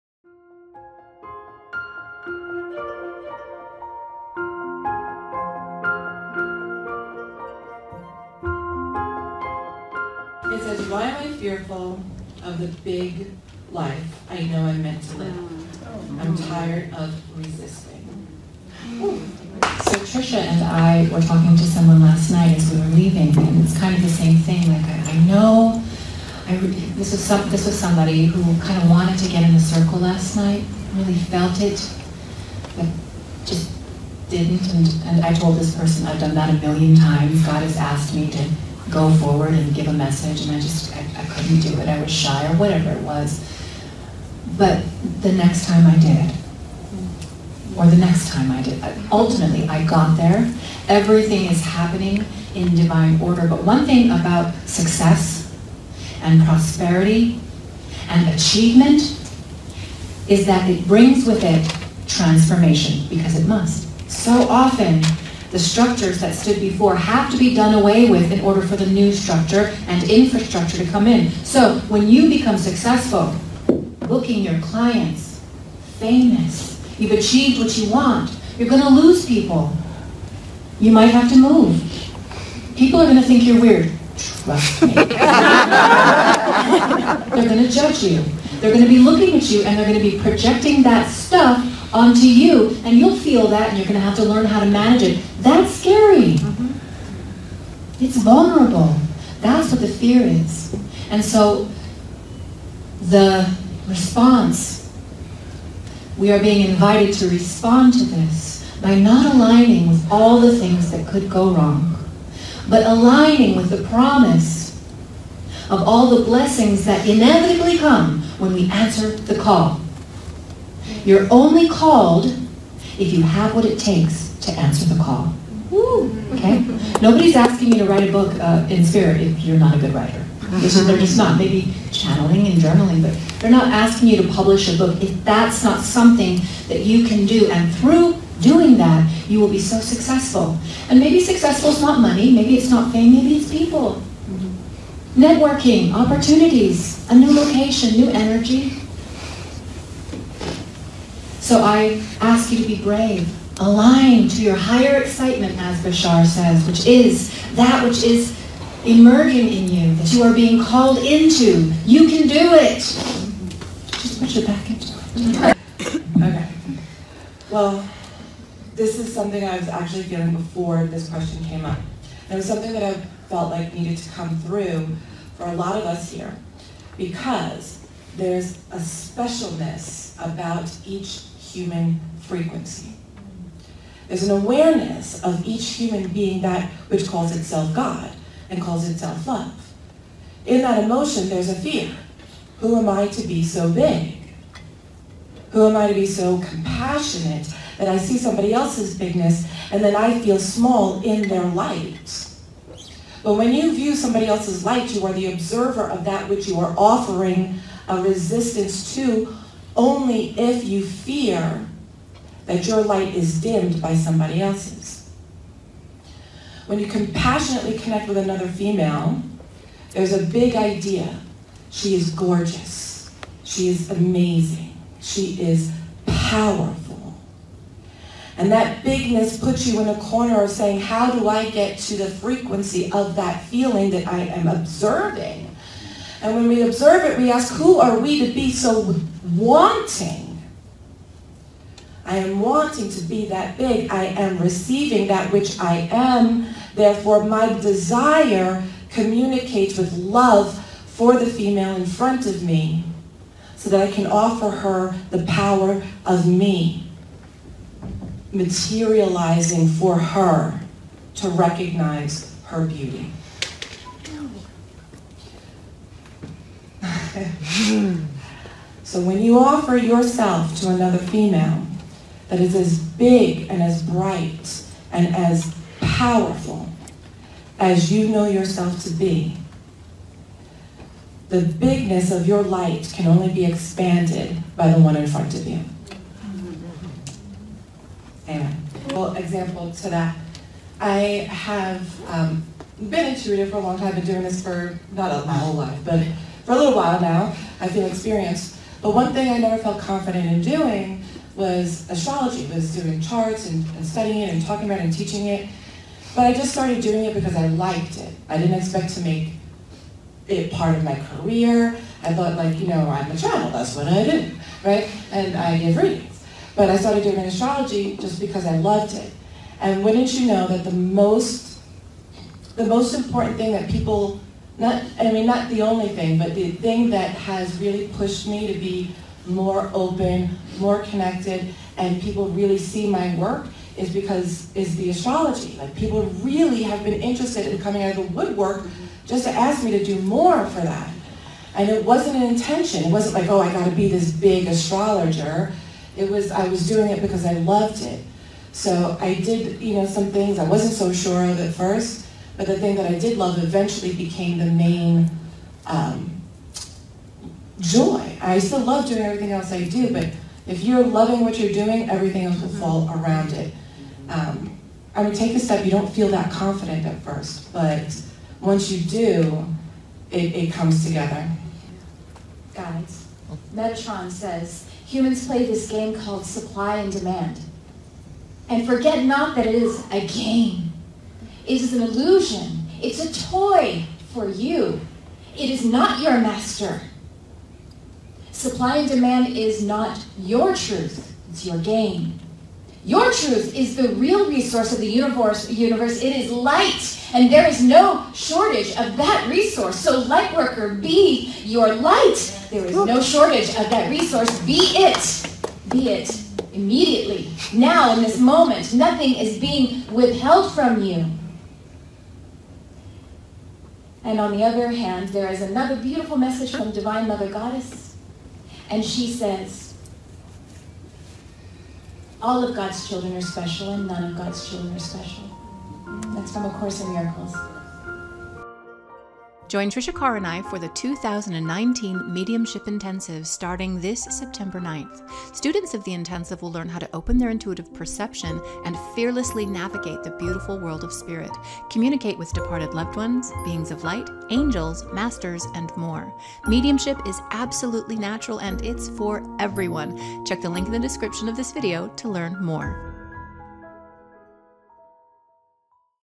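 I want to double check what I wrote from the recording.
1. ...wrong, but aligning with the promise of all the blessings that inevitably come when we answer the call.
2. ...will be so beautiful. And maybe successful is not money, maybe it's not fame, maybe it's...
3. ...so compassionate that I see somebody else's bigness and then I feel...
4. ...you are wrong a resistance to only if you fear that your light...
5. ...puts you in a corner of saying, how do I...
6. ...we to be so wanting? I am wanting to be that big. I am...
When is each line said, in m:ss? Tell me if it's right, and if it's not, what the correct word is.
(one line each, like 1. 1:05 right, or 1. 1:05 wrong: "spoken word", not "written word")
1. 1:51 right
2. 2:19 wrong: "successful", not "beautiful"
3. 3:16 right
4. 3:26 wrong: "offering", not "wrong"
5. 3:49 right
6. 3:57 right.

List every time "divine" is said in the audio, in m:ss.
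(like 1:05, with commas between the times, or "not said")
0:52, 6:56.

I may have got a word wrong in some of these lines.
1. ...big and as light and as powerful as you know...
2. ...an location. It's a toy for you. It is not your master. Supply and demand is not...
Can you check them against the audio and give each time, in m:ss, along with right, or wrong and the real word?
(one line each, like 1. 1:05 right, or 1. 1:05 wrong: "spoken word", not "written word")
1. 4:32 wrong: "bright", not "light"
2. 6:21 wrong: "illusion", not "location".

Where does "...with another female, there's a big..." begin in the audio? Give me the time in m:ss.
3:38.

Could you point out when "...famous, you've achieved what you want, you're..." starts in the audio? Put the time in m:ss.
1:15.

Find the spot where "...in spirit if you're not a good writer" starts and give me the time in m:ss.
2:08.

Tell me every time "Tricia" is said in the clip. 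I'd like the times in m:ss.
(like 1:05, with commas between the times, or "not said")
0:20, 7:09.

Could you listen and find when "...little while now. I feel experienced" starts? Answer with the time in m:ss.
4:56.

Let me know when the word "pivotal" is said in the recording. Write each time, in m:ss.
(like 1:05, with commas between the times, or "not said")
not said.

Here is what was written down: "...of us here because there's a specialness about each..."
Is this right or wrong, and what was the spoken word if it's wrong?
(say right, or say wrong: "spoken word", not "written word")
right.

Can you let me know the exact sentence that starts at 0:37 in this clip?
God has asked me to go forward and give a message, and I just I, I couldn't do it.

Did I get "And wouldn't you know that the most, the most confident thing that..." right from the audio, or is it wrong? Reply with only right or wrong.
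wrong.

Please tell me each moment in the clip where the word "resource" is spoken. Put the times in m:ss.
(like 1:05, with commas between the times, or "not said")
6:34, 6:39, 6:43.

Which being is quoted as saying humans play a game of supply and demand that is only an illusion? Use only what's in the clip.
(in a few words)
Metatron.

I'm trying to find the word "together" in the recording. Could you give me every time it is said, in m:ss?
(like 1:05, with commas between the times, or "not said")
6:10.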